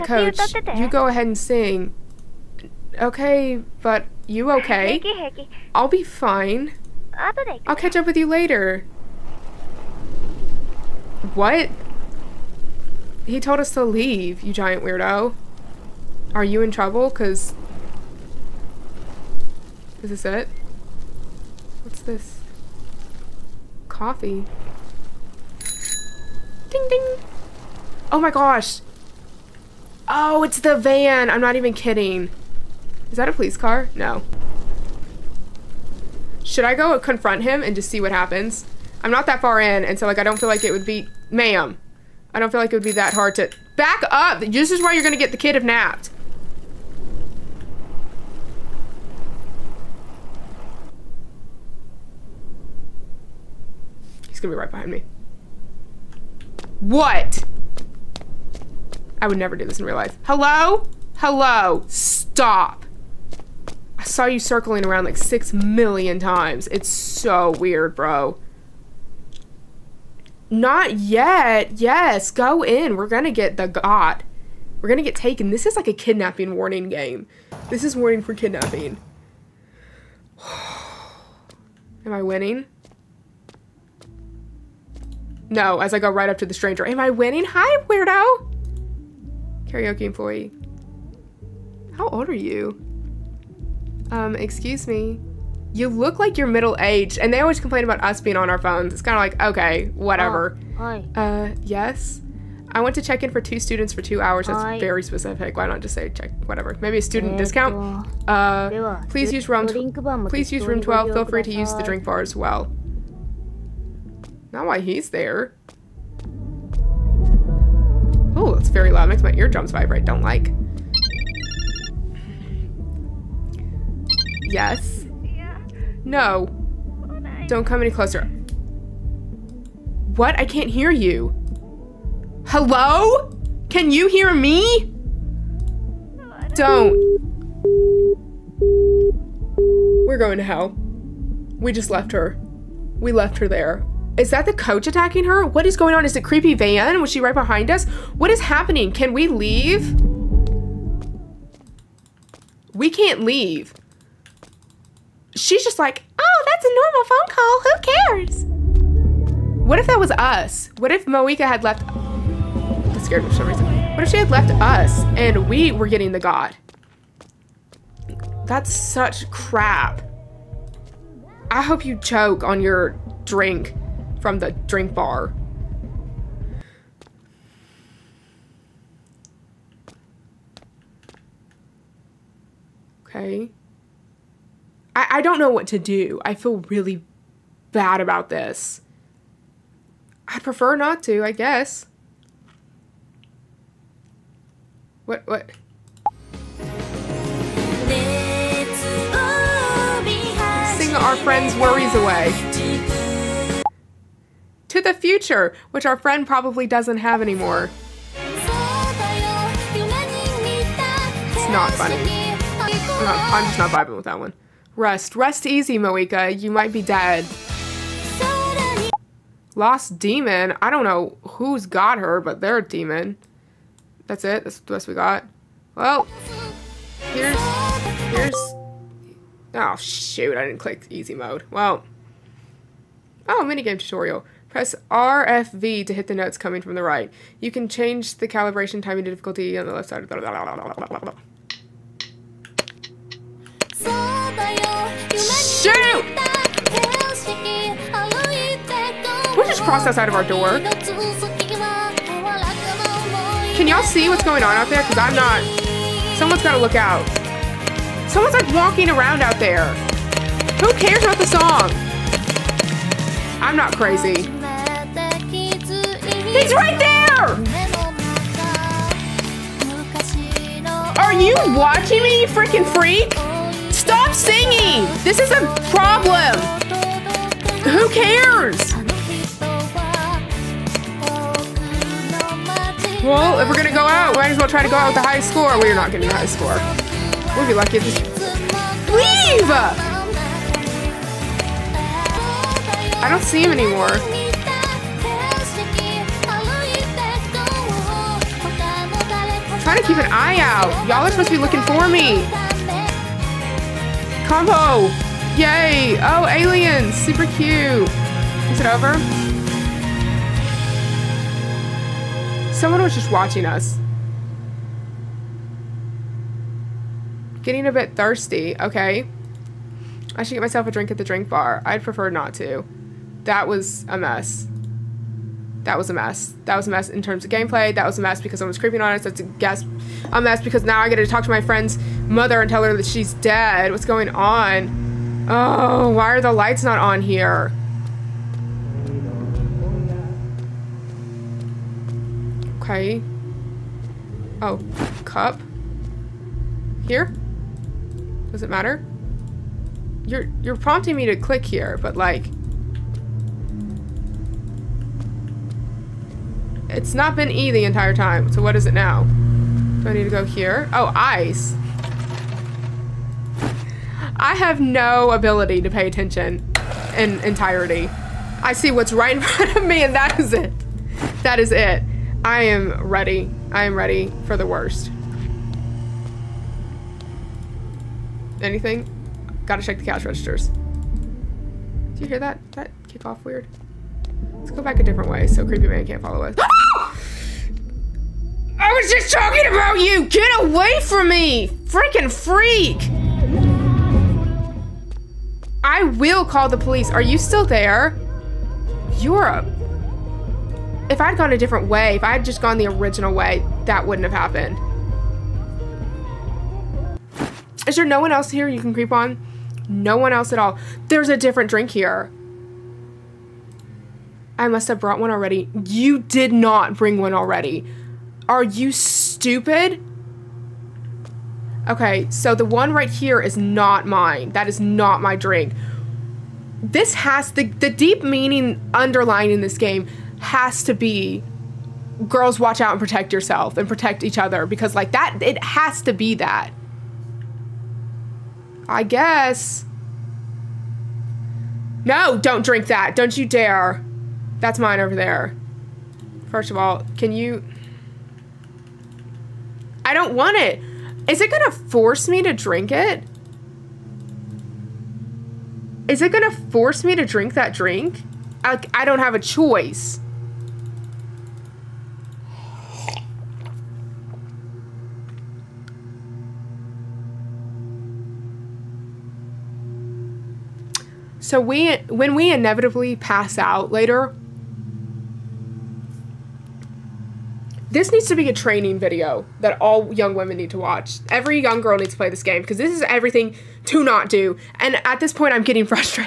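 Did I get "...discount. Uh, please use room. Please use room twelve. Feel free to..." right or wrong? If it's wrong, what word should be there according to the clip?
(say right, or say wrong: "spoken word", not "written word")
right.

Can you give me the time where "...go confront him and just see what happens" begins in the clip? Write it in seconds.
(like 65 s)
36 s.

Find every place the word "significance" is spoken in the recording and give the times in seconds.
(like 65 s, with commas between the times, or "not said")
not said.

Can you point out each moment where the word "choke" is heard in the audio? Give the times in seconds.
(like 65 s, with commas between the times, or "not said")
171 s.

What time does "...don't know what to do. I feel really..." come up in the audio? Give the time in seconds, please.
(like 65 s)
185 s.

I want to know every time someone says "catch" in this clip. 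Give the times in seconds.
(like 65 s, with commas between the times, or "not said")
7 s.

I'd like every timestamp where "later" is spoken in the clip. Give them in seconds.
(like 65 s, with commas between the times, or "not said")
8 s, 473 s.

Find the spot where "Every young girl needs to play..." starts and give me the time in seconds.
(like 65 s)
481 s.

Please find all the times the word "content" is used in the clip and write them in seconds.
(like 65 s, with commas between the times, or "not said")
not said.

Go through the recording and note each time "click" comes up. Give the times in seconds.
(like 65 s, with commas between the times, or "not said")
230 s, 351 s.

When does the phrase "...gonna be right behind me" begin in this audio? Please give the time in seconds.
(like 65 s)
54 s.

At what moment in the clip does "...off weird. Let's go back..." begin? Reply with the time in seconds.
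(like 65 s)
383 s.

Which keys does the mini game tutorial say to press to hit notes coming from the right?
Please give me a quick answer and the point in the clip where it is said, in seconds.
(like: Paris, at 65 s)
RFV, at 234 s.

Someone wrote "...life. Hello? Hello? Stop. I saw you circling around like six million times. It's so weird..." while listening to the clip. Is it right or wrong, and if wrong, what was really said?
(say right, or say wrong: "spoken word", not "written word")
right.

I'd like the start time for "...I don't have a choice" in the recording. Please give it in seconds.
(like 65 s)
458 s.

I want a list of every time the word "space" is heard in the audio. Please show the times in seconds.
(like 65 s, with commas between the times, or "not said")
not said.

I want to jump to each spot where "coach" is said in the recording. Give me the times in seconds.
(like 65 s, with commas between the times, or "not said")
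0 s, 144 s.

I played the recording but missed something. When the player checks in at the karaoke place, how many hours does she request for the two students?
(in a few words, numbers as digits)
2.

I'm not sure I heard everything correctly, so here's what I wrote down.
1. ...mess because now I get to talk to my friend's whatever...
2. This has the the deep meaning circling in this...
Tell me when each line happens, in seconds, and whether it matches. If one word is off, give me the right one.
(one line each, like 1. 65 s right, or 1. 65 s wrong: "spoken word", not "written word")
1. 330 s wrong: "mother", not "whatever"
2. 426 s wrong: "underlying", not "circling".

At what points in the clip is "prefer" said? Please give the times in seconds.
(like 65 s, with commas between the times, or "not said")
190 s, 321 s.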